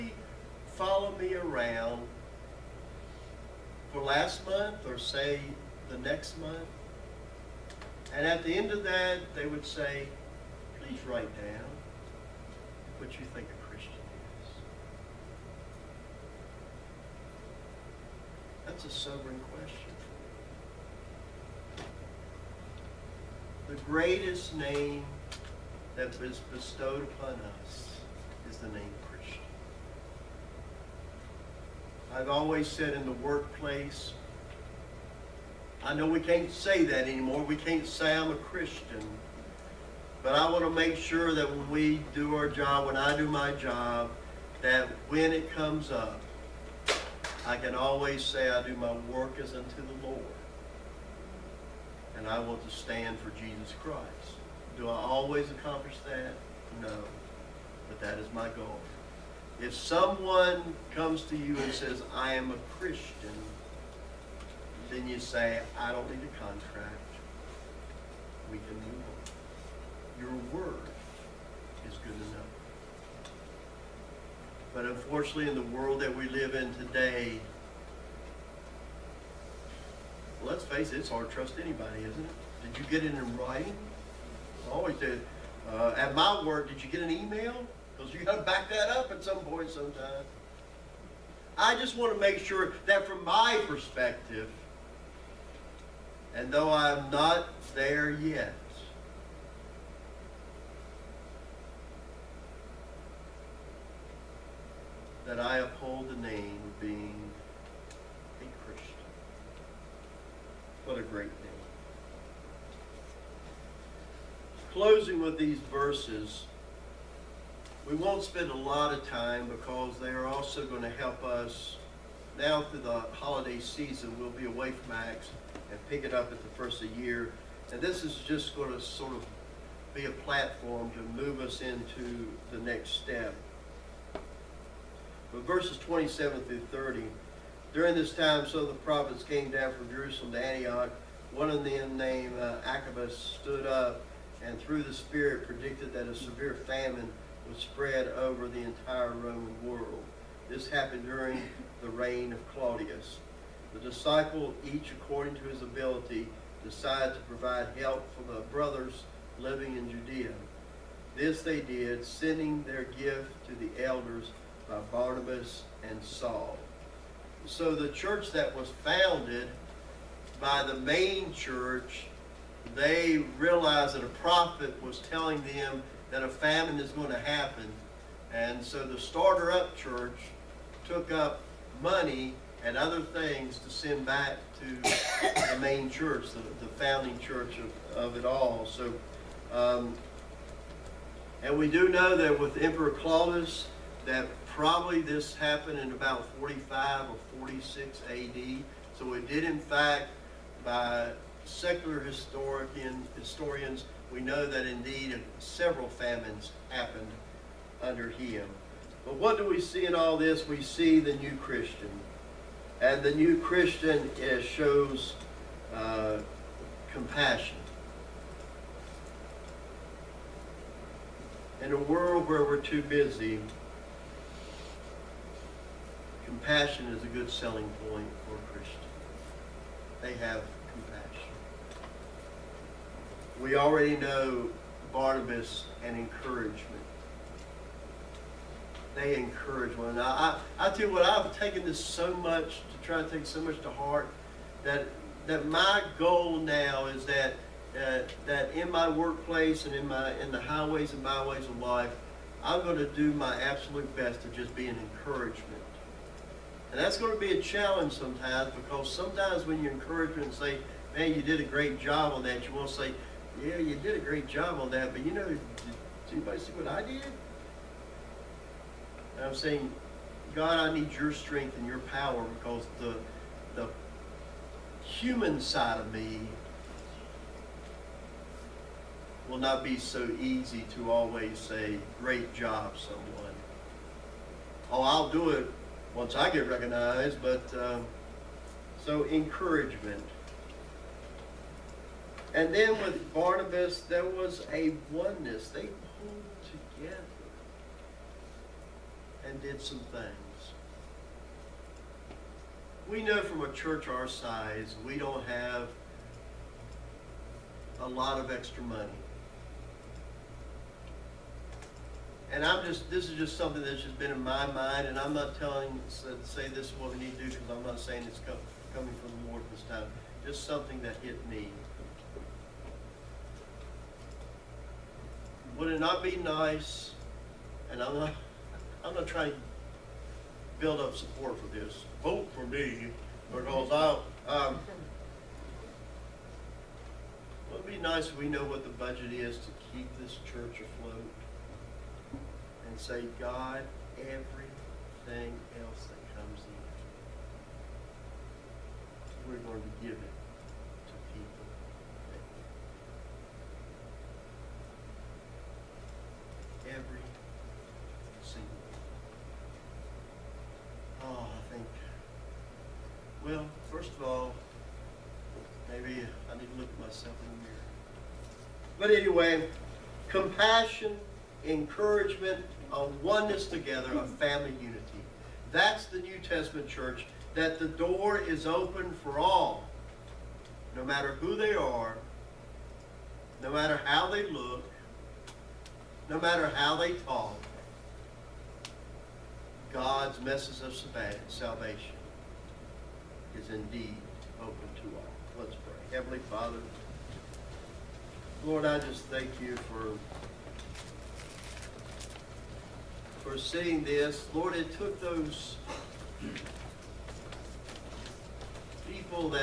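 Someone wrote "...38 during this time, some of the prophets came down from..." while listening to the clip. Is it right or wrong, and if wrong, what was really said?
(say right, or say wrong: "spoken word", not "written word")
wrong: "30", not "38".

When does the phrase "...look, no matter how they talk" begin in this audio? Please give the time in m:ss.
6:24.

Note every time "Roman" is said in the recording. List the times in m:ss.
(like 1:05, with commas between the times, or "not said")
2:29.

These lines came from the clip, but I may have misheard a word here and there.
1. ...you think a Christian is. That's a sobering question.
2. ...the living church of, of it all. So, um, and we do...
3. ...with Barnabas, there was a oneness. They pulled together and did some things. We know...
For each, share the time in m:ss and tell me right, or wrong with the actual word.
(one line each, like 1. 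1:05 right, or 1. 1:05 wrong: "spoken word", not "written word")
1. 0:13 right
2. 3:06 wrong: "founding", not "living"
3. 4:52 right.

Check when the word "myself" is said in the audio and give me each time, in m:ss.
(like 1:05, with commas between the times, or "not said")
6:06.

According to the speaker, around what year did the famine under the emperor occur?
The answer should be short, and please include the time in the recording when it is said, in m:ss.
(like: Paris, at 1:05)
45 AD, at 3:16.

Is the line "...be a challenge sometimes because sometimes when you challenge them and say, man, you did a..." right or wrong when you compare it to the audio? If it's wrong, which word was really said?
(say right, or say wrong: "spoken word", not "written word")
wrong: "encourage", not "challenge".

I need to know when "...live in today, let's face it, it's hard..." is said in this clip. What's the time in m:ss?
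1:16.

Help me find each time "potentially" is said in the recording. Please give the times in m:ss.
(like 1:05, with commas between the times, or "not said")
not said.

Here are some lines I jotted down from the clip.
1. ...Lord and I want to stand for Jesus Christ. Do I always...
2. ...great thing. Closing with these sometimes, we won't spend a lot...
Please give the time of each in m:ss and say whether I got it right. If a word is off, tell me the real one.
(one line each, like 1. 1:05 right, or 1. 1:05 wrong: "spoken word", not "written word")
1. 0:50 right
2. 1:51 wrong: "verses", not "sometimes".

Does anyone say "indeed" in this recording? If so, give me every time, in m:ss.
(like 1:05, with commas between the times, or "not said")
3:24, 6:33.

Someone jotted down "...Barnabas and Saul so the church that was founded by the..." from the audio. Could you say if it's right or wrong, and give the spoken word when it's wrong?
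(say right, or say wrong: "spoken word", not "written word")
right.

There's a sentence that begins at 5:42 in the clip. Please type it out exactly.
and say, God, everything else that comes in, we're going to give it to people.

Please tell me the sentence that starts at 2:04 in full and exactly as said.
We'll be away from Acts and pick it up at the first of the year.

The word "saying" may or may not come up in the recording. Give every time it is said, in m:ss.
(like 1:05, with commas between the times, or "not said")
4:29, 5:17.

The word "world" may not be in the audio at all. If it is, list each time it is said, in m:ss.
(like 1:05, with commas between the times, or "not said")
1:15, 2:29, 3:41.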